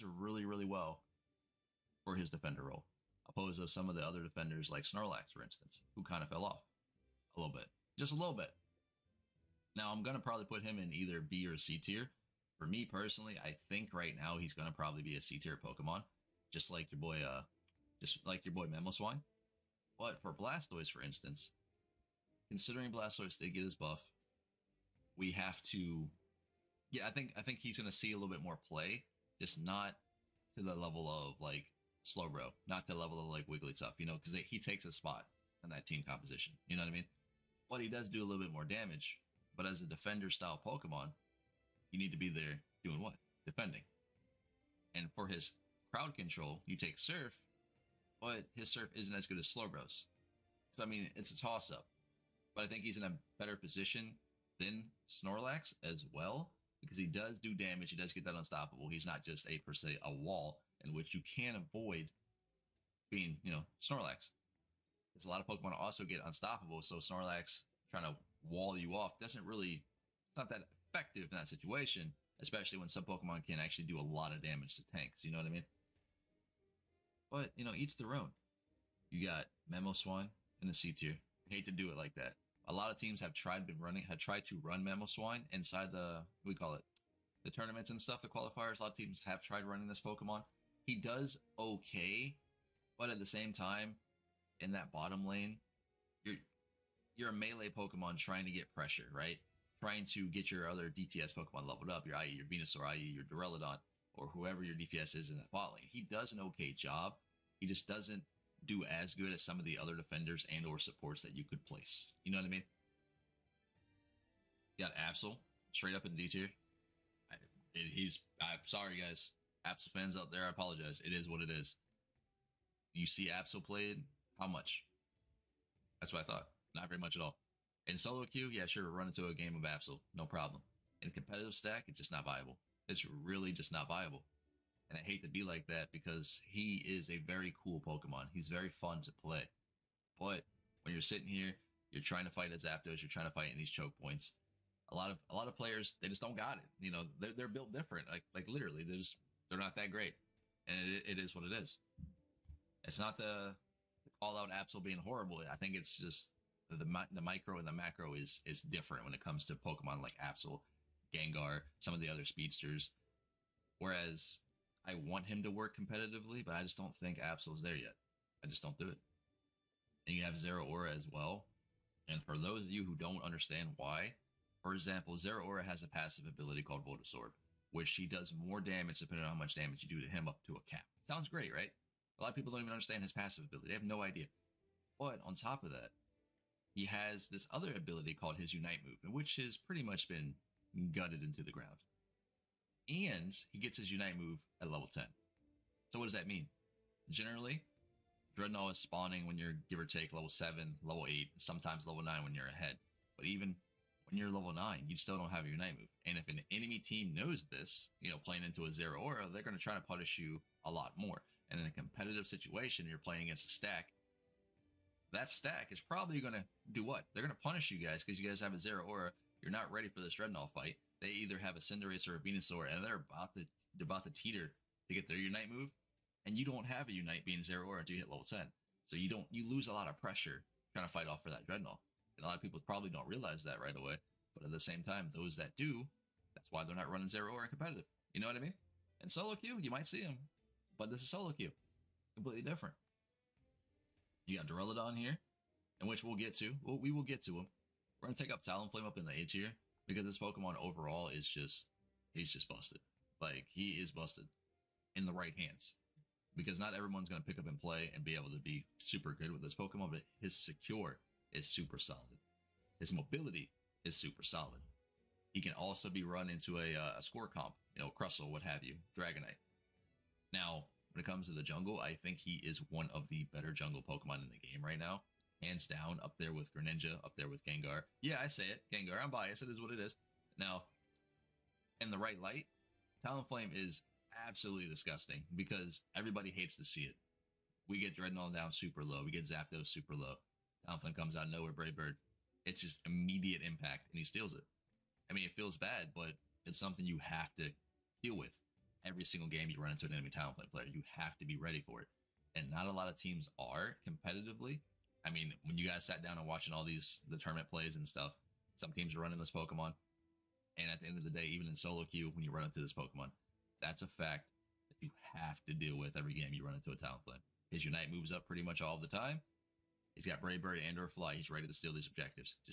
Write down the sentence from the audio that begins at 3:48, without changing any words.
So you don't you lose a lot of pressure trying to fight off for that Drednaw.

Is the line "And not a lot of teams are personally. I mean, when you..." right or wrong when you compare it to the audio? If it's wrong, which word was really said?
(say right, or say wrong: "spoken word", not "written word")
wrong: "competitively", not "personally".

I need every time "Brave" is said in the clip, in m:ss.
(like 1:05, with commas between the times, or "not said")
4:51, 5:20.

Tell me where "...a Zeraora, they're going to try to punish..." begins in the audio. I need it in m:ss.
3:28.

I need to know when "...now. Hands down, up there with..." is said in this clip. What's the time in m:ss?
4:34.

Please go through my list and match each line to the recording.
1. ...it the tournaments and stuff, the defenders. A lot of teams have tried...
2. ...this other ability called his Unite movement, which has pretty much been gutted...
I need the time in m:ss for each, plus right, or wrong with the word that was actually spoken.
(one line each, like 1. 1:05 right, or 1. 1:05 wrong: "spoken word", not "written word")
1. 1:26 wrong: "qualifiers", not "defenders"
2. 3:07 right.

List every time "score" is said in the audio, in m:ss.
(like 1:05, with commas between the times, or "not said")
4:27.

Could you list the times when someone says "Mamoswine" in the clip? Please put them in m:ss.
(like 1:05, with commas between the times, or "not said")
0:18, 1:19, 1:24.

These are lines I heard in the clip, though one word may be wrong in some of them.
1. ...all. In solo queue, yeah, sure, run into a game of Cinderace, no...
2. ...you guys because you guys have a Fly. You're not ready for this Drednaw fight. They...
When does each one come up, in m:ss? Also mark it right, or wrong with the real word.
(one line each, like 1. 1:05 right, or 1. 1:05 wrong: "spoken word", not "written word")
1. 2:07 wrong: "Absol", not "Cinderace"
2. 3:37 wrong: "Zeraora", not "Fly".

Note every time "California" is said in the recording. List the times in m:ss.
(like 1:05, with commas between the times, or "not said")
not said.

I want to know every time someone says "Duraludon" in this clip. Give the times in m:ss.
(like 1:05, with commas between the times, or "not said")
1:43, 4:04.